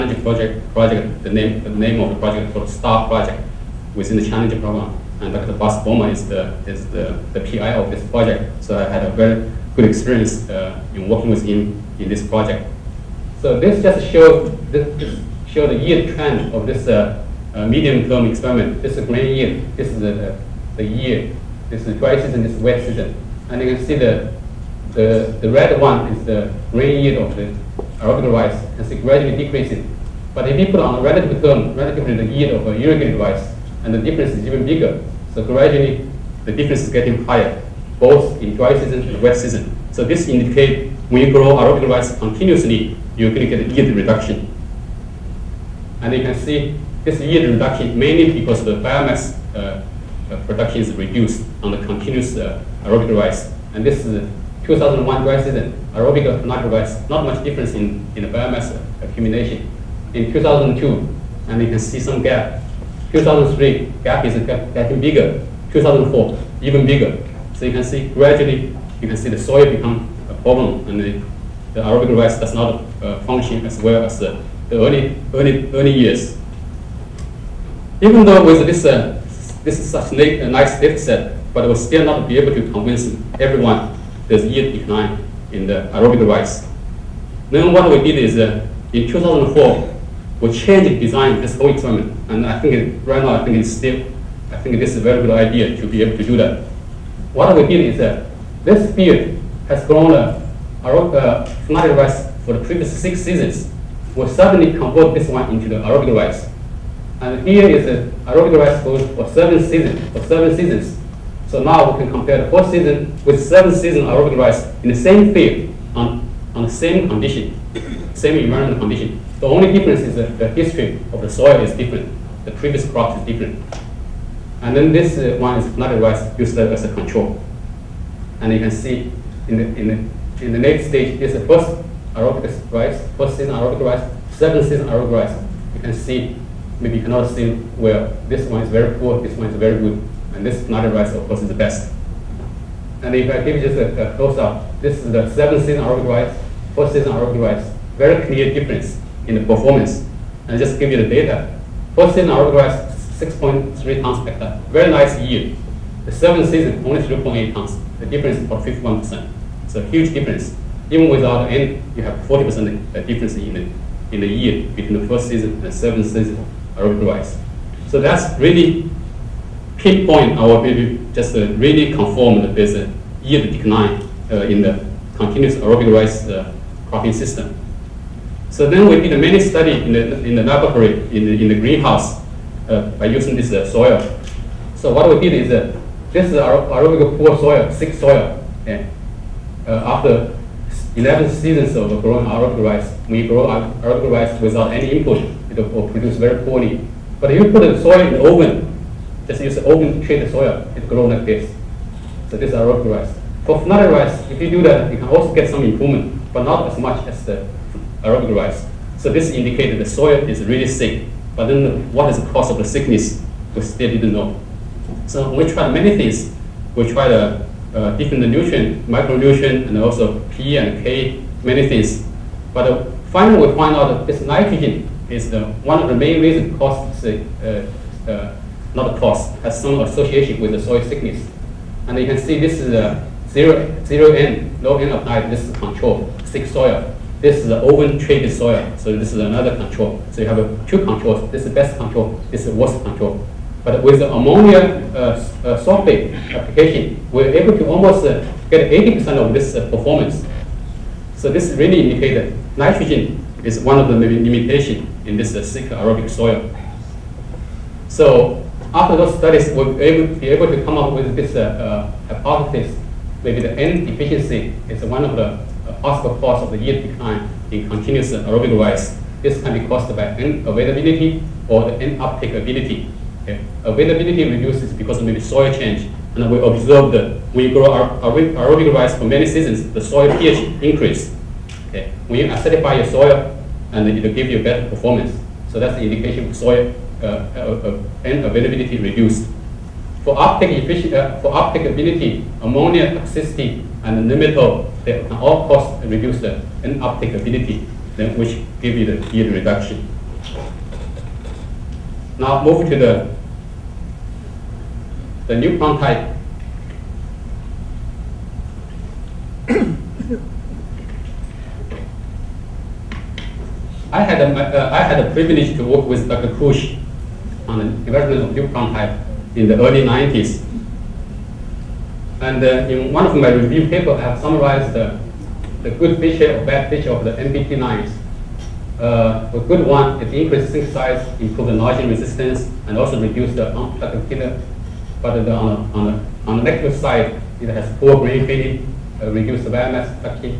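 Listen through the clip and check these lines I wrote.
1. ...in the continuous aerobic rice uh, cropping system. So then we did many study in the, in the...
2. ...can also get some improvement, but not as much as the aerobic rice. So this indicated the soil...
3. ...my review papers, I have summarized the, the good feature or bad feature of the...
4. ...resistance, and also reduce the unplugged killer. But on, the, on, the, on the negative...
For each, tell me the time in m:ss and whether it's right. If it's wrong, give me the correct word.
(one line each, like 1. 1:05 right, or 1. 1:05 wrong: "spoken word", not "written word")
1. 2:54 right
2. 3:24 right
3. 5:23 right
4. 5:31 right.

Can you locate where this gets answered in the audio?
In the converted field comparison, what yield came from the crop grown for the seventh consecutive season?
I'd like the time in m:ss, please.
2:37.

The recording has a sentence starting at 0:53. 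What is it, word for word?
And this is 2001 dry season, aerobic natural rice, not much difference in, in the biomass accumulation.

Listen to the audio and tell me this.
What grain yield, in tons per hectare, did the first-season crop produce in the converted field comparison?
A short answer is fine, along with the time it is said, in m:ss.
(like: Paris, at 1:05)
6.3 tons per hectare, at 2:33.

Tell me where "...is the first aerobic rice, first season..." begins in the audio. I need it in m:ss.
2:11.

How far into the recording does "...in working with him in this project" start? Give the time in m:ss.
0:10.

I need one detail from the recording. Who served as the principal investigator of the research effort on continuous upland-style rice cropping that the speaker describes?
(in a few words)
Dr. Bas Bouman.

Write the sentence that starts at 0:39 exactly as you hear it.
So this indicates when you grow aerobic rice continuously, you're going to get a yield reduction.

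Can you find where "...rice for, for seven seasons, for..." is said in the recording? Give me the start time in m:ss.
1:48.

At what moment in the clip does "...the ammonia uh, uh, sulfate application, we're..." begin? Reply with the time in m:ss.
4:03.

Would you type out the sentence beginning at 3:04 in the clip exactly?
So what we did is, uh, this is our aerobic poor soil, sick soil.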